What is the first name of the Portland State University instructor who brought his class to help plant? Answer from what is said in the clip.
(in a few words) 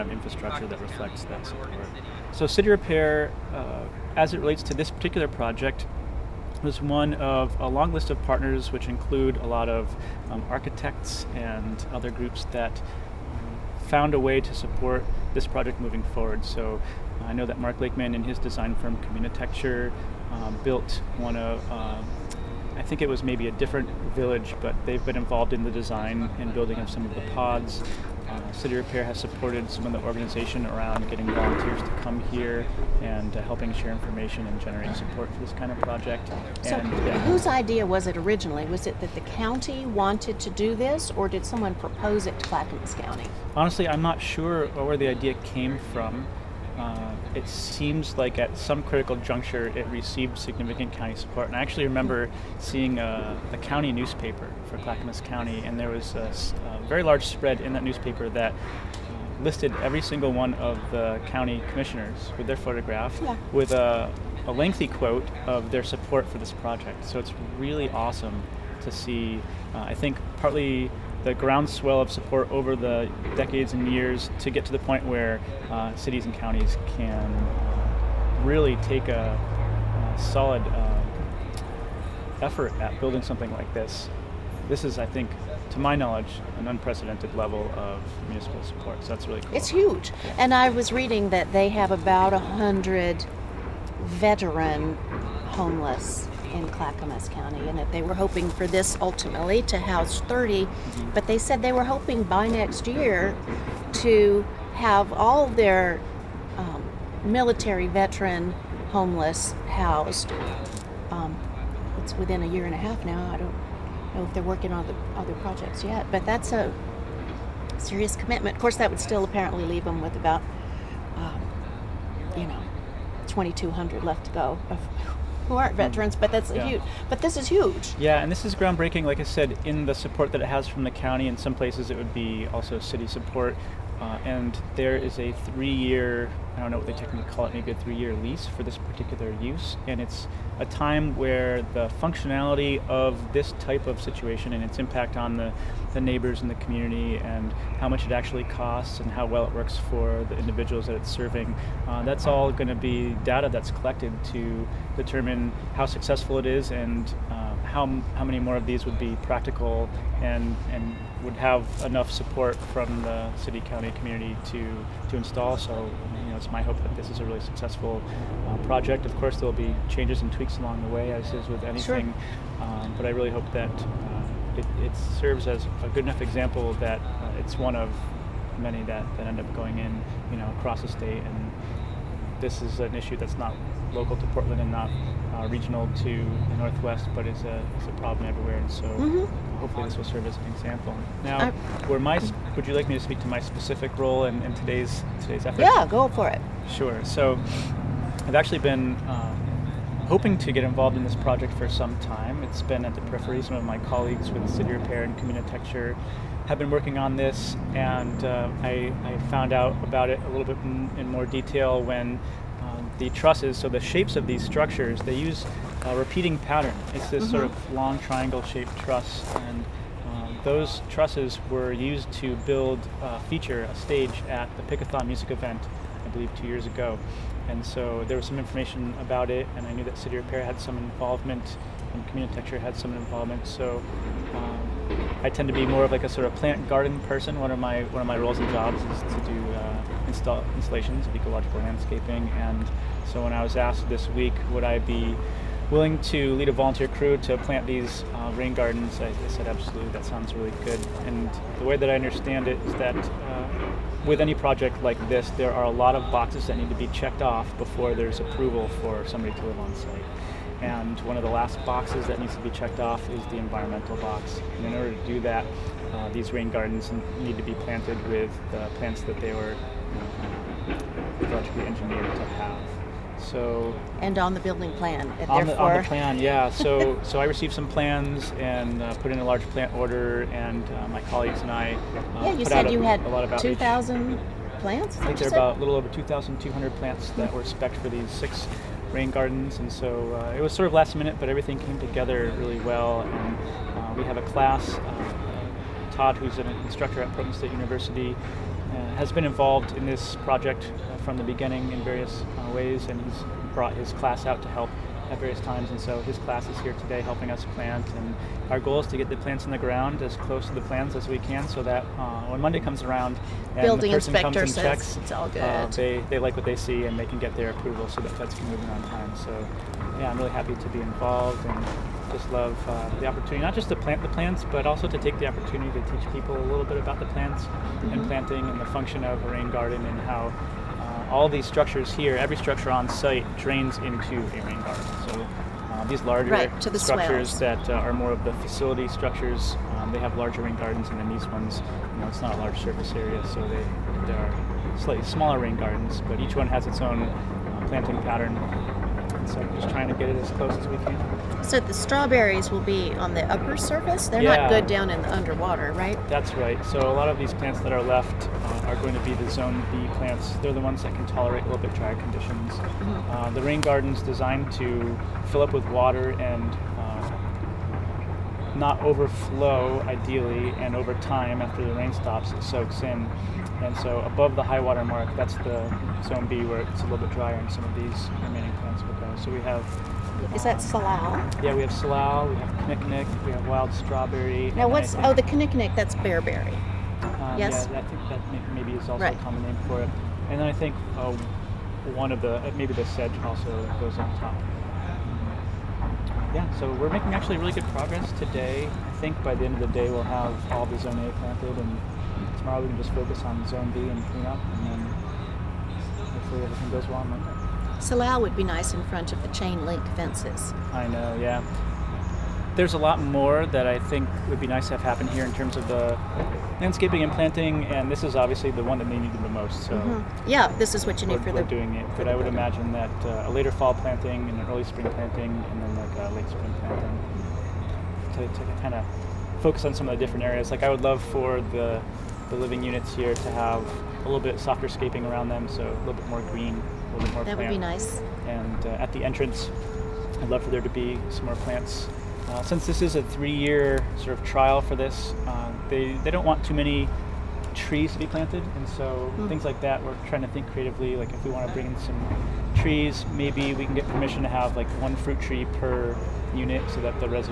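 Todd.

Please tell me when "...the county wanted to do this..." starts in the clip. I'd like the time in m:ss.
0:39.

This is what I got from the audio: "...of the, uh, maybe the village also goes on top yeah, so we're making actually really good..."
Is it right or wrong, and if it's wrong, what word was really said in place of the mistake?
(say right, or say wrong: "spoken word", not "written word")
wrong: "sedge", not "village".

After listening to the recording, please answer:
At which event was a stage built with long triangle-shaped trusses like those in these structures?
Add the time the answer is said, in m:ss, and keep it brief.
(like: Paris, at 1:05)
Pickathon, at 3:44.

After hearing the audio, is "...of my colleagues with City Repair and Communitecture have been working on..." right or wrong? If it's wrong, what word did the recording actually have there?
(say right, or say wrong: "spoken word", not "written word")
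right.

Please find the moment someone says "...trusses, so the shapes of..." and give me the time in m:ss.
3:33.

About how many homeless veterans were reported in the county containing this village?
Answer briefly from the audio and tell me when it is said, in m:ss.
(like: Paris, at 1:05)
100, at 1:32.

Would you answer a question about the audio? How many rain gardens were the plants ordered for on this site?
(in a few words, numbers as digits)
6.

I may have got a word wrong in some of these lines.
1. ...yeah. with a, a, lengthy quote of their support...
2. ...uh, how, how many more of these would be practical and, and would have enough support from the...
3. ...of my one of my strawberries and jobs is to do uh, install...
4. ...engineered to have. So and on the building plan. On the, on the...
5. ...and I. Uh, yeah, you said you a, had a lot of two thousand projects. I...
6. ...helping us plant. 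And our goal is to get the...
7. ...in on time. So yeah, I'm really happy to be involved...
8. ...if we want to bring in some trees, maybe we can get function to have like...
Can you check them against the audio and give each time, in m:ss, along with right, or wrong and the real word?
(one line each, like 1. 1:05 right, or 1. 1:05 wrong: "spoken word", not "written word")
1. 1:03 right
2. 2:37 right
3. 3:57 wrong: "roles", not "strawberries"
4. 4:31 right
5. 4:41 wrong: "plants", not "projects"
6. 5:07 right
7. 5:18 right
8. 7:31 wrong: "permission", not "function".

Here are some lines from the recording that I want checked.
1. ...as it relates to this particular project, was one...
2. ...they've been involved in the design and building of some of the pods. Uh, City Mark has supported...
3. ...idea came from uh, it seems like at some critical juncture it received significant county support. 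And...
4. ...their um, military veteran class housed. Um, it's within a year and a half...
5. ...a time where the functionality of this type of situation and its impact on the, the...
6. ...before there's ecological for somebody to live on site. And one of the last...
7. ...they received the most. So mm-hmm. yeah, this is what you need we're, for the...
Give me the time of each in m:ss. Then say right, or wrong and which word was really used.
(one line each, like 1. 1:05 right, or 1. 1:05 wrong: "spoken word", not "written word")
1. 0:04 right
2. 0:24 wrong: "Repair", not "Mark"
3. 0:45 right
4. 1:45 wrong: "homeless", not "class"
5. 2:20 right
6. 4:17 wrong: "approval", not "ecological"
7. 6:58 wrong: "needed", not "received".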